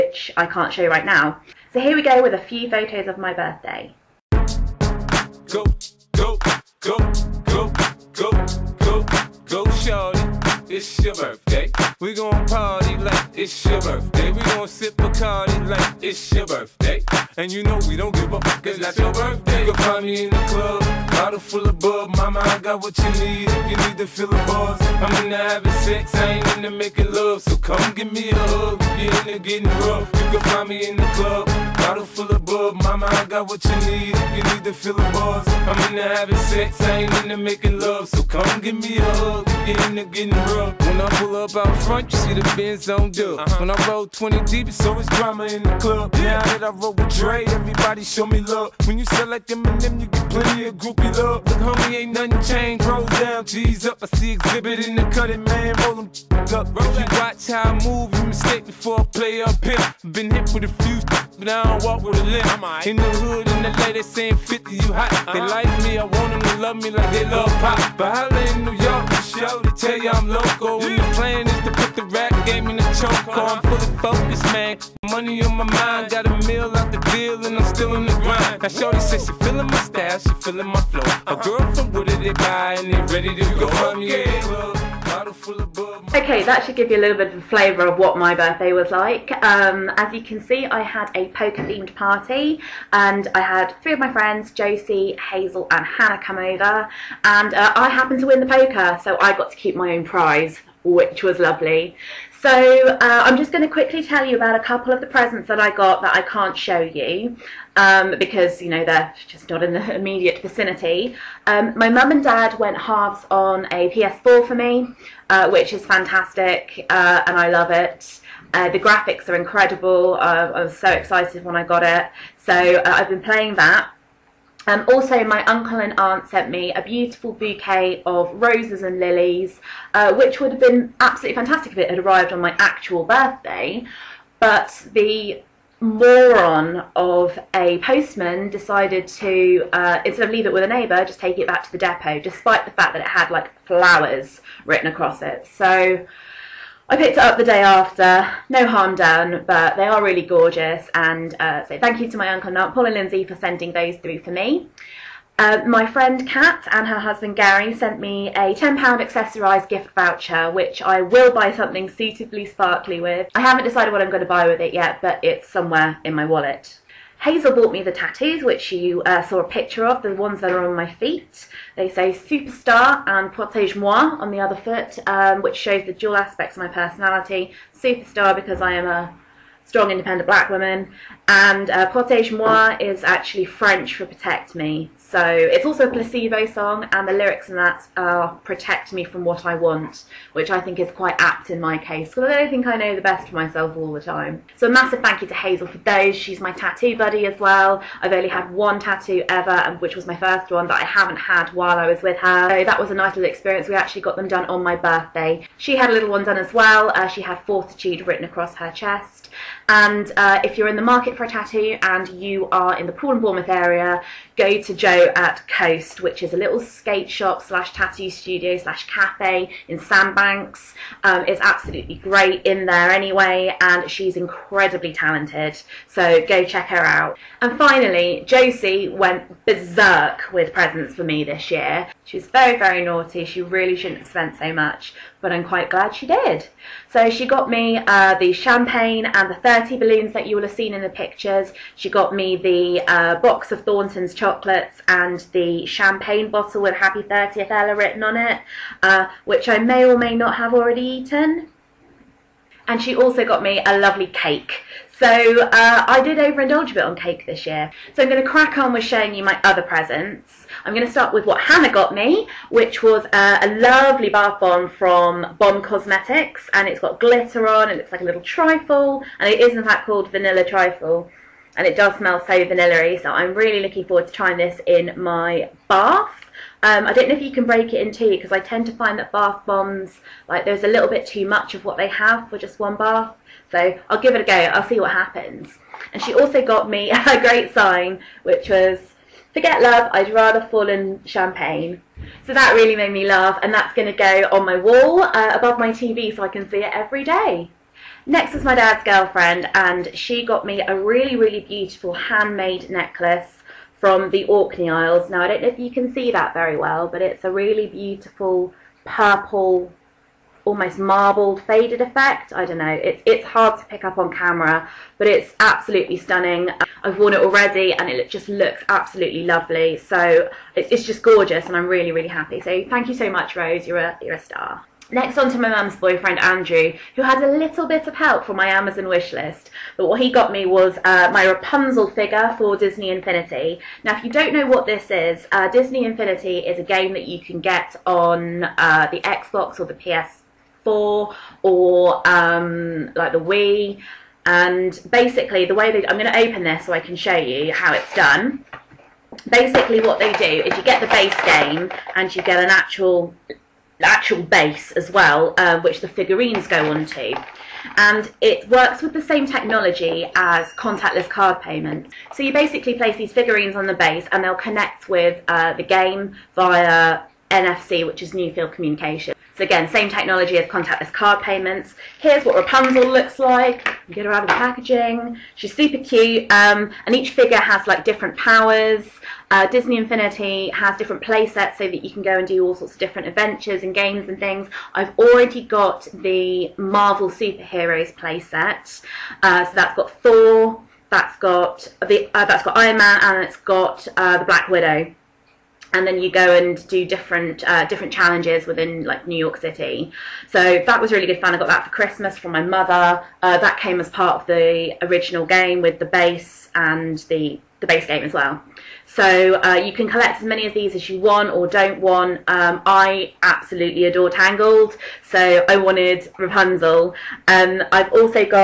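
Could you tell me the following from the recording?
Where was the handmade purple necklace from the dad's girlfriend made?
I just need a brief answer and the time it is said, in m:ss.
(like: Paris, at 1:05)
Orkney Isles, at 5:04.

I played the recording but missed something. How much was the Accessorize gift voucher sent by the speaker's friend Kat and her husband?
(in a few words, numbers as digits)
£10.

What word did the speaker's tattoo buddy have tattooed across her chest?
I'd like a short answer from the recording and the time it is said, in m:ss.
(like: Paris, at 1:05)
Fortitude, at 3:27.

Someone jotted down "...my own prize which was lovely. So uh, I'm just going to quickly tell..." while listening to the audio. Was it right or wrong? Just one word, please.
right.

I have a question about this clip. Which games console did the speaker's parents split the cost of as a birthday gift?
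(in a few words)
PS4.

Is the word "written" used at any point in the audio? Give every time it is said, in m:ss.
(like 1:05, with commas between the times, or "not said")
2:24, 3:28, 4:07.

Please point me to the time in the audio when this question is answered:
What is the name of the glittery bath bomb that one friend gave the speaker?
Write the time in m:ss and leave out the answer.
4:30.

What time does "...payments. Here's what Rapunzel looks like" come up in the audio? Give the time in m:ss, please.
6:11.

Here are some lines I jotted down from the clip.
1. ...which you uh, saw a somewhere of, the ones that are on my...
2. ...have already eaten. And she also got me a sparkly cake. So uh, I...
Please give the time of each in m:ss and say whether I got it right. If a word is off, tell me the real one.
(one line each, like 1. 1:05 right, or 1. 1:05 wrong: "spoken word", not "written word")
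1. 2:48 wrong: "picture", not "somewhere"
2. 4:10 wrong: "lovely", not "sparkly".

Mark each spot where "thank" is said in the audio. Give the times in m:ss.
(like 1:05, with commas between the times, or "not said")
2:31, 3:15, 5:22.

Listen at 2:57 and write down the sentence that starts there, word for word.
Superstar because I am a strong, independent black woman, and uh, Protège-moi is actually French for protect me.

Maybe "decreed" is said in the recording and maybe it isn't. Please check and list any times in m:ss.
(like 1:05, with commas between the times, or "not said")
not said.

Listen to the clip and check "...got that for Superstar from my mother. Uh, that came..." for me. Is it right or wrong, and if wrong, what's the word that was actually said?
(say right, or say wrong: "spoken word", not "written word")
wrong: "Christmas", not "Superstar".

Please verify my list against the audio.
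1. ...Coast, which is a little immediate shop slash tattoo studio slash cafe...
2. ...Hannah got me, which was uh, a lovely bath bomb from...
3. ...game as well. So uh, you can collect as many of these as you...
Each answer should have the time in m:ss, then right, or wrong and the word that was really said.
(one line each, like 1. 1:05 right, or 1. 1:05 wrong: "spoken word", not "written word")
1. 3:35 wrong: "skate", not "immediate"
2. 4:21 right
3. 6:47 right.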